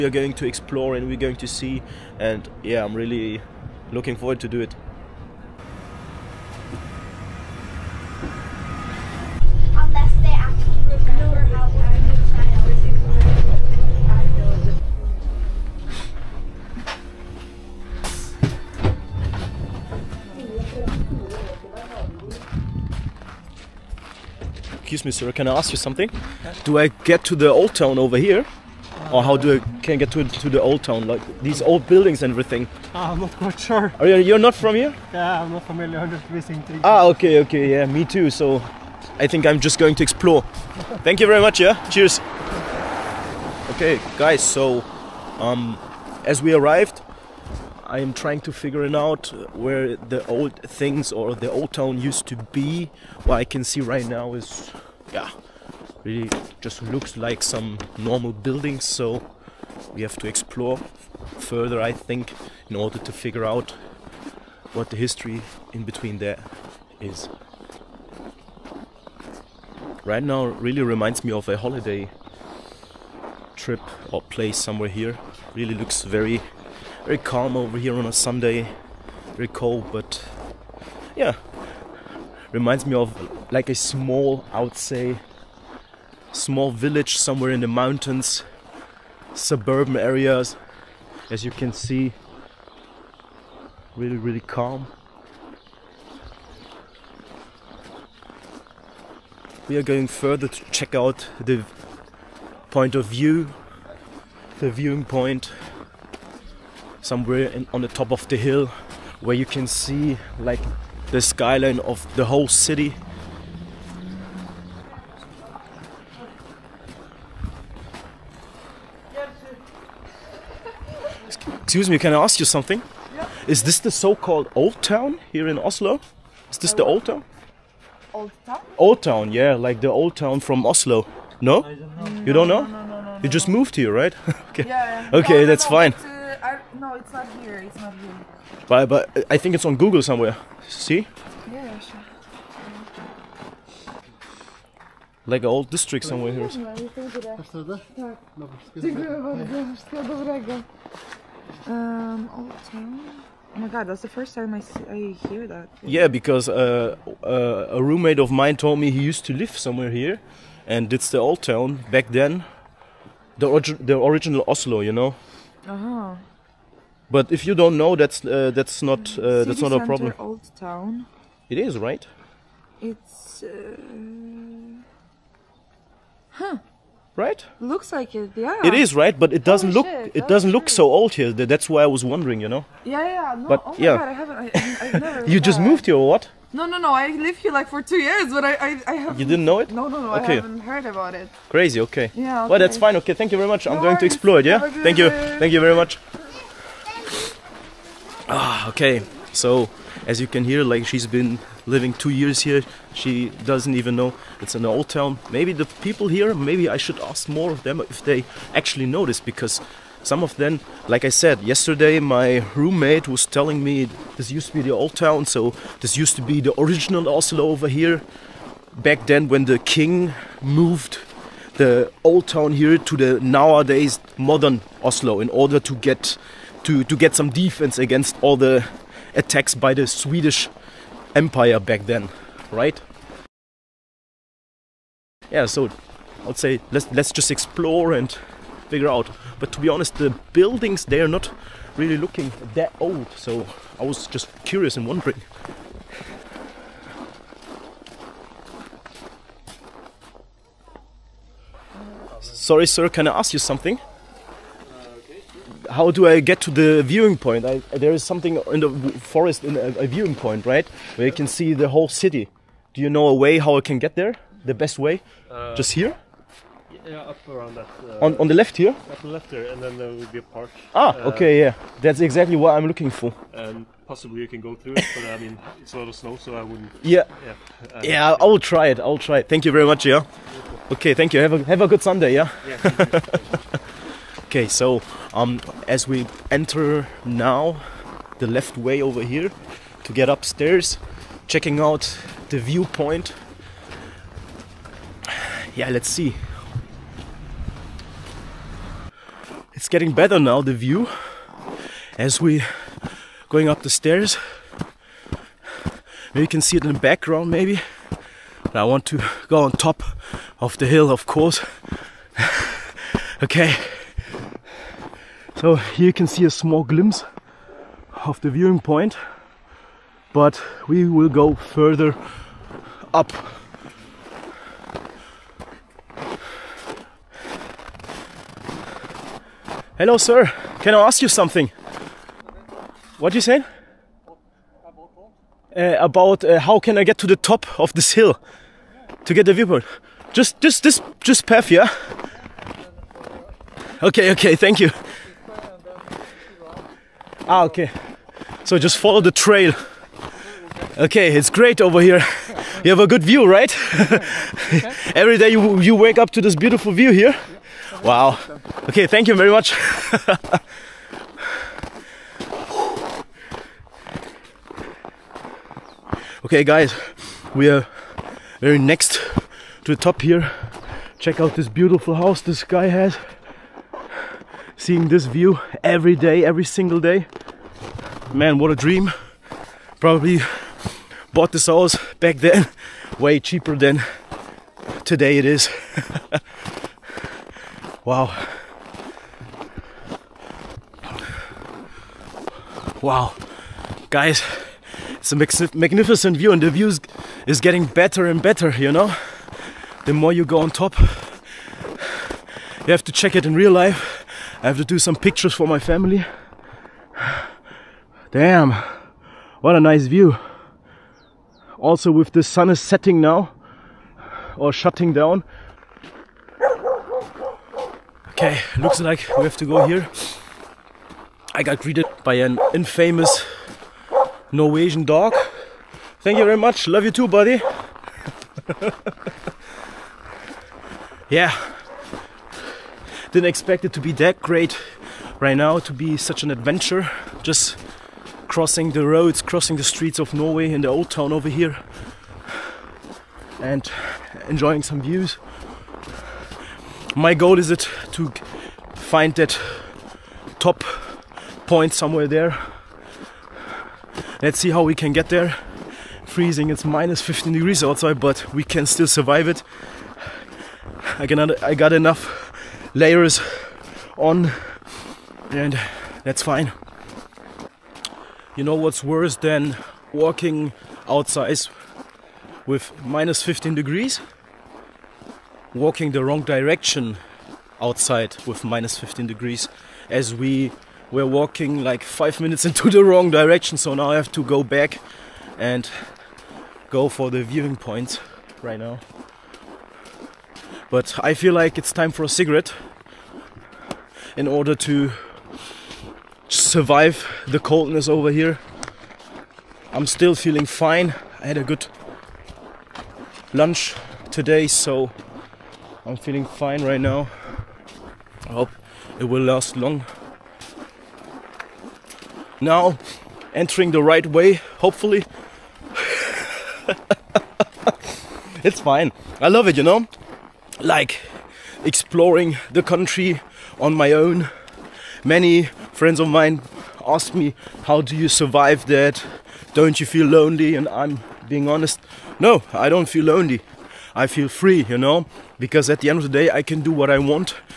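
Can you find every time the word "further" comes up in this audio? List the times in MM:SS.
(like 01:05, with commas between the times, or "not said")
01:01, 01:40, 05:21.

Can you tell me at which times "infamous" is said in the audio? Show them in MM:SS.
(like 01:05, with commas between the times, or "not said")
07:02.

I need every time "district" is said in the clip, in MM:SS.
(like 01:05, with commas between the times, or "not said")
02:25.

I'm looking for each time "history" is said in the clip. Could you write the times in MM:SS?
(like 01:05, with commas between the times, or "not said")
01:04.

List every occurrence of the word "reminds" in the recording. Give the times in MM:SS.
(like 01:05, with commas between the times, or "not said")
01:10, 01:22.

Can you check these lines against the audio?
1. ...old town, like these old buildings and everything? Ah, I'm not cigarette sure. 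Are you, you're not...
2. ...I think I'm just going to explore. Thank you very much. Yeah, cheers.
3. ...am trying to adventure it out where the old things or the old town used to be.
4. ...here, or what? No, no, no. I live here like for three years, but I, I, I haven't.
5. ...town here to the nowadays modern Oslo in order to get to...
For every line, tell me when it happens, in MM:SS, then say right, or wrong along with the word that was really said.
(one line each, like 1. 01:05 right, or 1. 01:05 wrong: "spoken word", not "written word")
1. 00:30 wrong: "quite", not "cigarette"
2. 00:39 right
3. 00:47 wrong: "figure", not "adventure"
4. 03:05 wrong: "two", not "three"
5. 03:42 right.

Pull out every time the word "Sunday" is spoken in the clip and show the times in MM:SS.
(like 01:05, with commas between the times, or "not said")
01:18, 04:41.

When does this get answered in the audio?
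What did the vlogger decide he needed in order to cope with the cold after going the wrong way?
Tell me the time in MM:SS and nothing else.
08:12.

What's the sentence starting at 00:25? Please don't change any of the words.
excuse me, sir, can I ask you something?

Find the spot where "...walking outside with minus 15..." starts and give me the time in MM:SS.
07:49.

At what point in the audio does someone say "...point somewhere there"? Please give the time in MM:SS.
07:31.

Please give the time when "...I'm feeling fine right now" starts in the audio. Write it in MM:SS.
08:25.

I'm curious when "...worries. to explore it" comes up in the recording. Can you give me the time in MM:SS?
03:13.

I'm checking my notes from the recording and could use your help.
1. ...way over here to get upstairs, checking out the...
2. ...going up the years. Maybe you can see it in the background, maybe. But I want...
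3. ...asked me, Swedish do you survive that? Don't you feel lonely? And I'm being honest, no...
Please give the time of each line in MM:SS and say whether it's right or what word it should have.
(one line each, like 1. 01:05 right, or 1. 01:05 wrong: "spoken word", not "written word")
1. 04:48 right
2. 05:03 wrong: "stairs", not "years"
3. 08:46 wrong: "How", not "Swedish".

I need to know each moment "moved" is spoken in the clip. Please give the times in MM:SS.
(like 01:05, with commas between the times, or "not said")
02:13, 03:05, 03:40.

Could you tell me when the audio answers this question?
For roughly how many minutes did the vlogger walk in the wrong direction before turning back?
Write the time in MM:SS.
08:01.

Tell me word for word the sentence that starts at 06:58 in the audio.
Okay, looks like we have to go here.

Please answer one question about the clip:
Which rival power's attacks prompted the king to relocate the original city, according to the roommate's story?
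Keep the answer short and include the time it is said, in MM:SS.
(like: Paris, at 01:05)
Swedish Empire, at 03:49.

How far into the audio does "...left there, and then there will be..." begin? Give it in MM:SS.
04:29.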